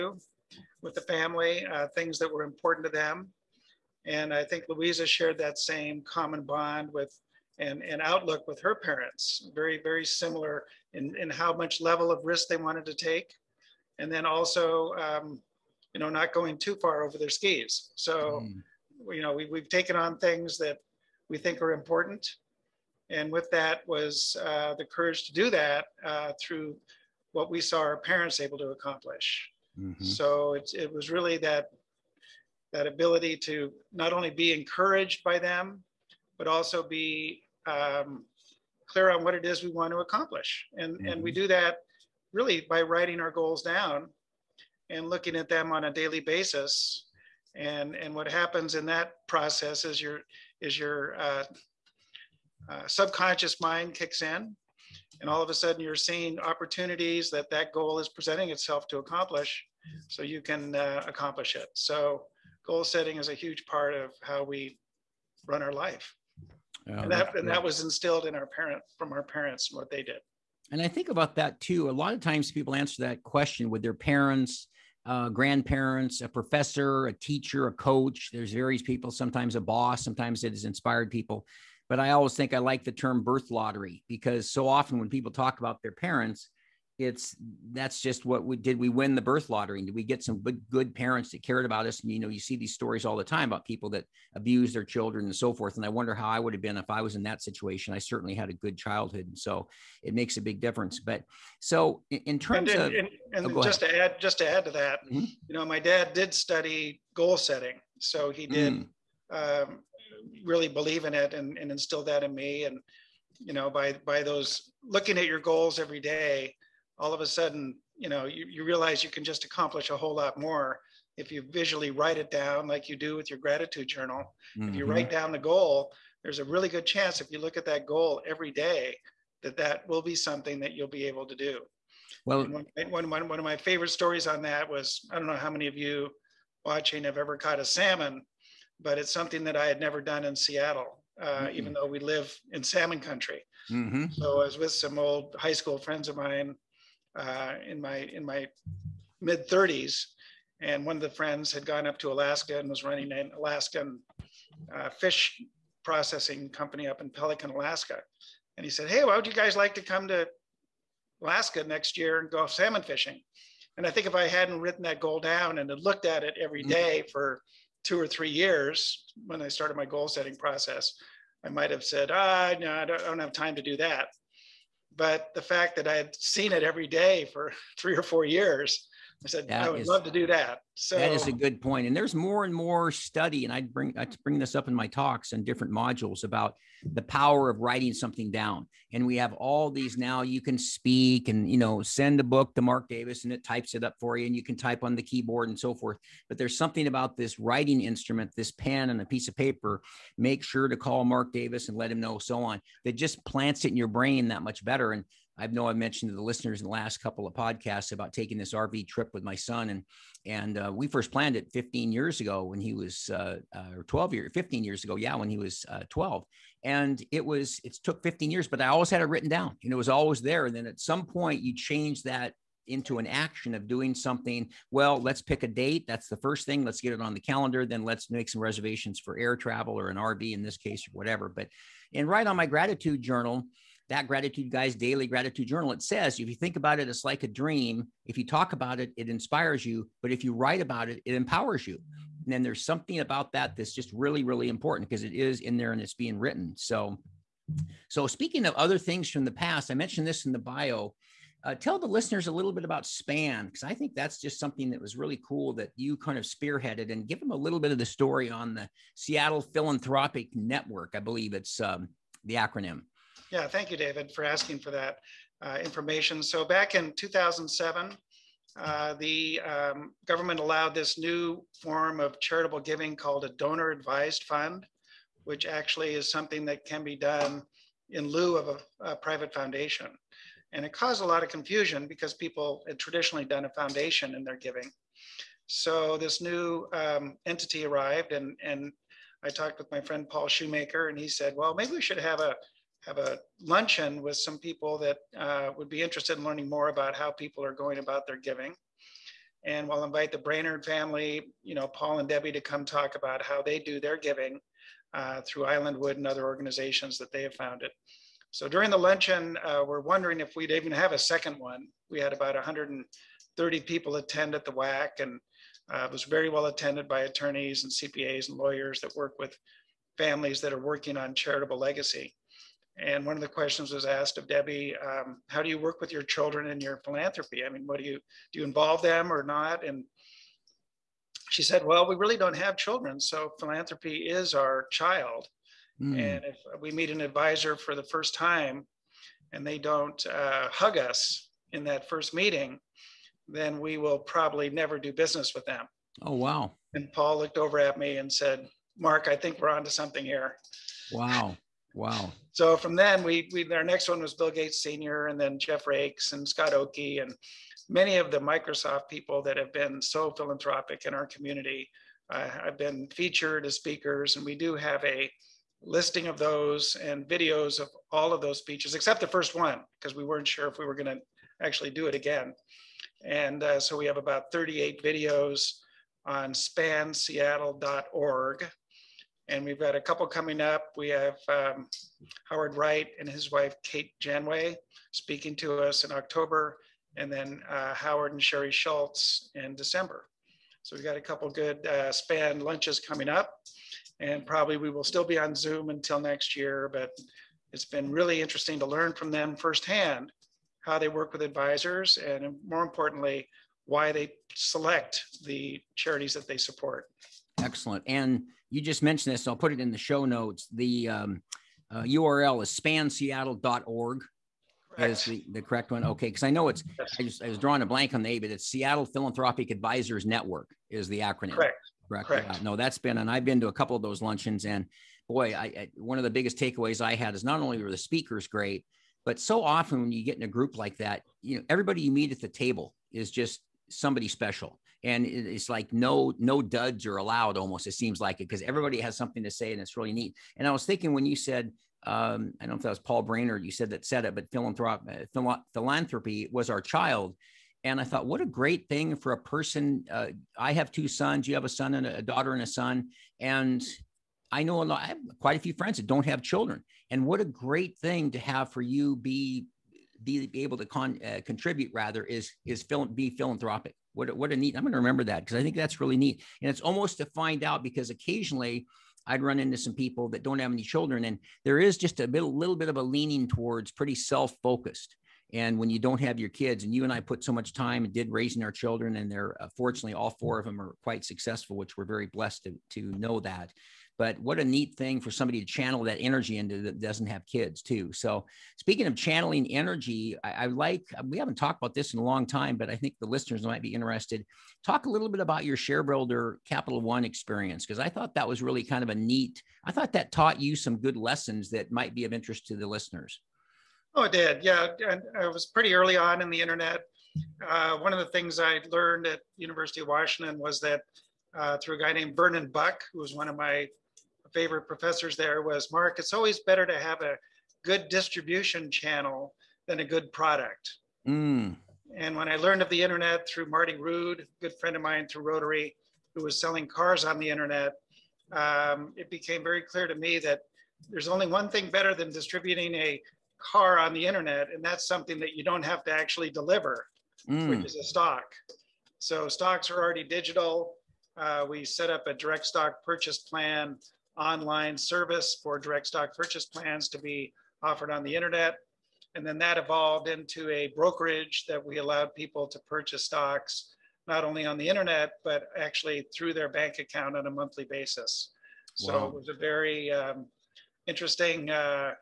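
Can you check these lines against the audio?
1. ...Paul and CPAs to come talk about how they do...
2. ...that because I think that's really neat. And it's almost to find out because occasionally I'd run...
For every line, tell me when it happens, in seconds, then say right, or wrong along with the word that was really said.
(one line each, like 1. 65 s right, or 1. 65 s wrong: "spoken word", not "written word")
1. 301 s wrong: "Debbie", not "CPAs"
2. 465 s right.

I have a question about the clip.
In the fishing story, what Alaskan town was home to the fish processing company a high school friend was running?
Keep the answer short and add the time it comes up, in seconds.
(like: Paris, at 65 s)
Pelican, at 157 s.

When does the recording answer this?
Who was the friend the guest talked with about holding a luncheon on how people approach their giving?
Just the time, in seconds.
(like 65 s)
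290 s.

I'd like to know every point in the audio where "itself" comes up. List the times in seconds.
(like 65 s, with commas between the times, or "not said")
58 s.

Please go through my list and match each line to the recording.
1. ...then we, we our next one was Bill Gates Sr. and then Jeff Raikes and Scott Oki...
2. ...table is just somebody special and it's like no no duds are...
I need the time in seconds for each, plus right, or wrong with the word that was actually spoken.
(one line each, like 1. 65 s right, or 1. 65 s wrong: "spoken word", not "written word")
1. 352 s right
2. 432 s right.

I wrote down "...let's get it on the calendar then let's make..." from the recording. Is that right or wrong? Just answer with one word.
right.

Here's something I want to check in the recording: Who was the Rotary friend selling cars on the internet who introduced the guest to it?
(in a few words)
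Marty Rude.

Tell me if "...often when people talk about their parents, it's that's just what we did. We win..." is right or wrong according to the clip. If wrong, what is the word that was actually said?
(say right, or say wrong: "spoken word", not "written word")
right.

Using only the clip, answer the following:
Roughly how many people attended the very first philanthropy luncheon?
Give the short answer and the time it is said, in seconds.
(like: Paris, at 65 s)
130, at 312 s.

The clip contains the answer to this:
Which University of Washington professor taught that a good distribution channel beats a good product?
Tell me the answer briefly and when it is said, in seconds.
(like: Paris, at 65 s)
Vernon Buck, at 512 s.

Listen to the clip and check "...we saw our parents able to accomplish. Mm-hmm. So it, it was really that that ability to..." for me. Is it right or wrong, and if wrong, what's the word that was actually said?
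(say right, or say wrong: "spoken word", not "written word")
right.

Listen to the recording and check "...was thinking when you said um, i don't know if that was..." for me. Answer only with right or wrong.
right.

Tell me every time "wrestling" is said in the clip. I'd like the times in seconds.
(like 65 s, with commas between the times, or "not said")
not said.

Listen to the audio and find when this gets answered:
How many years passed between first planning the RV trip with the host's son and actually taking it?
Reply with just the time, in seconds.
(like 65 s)
217 s.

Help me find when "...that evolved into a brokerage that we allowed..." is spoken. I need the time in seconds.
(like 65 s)
549 s.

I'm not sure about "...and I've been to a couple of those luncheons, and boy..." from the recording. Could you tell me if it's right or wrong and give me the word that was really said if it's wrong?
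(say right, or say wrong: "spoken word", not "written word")
right.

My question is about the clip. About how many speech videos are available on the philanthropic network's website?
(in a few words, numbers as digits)
38.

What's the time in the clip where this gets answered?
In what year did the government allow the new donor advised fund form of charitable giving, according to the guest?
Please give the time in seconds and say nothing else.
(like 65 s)
266 s.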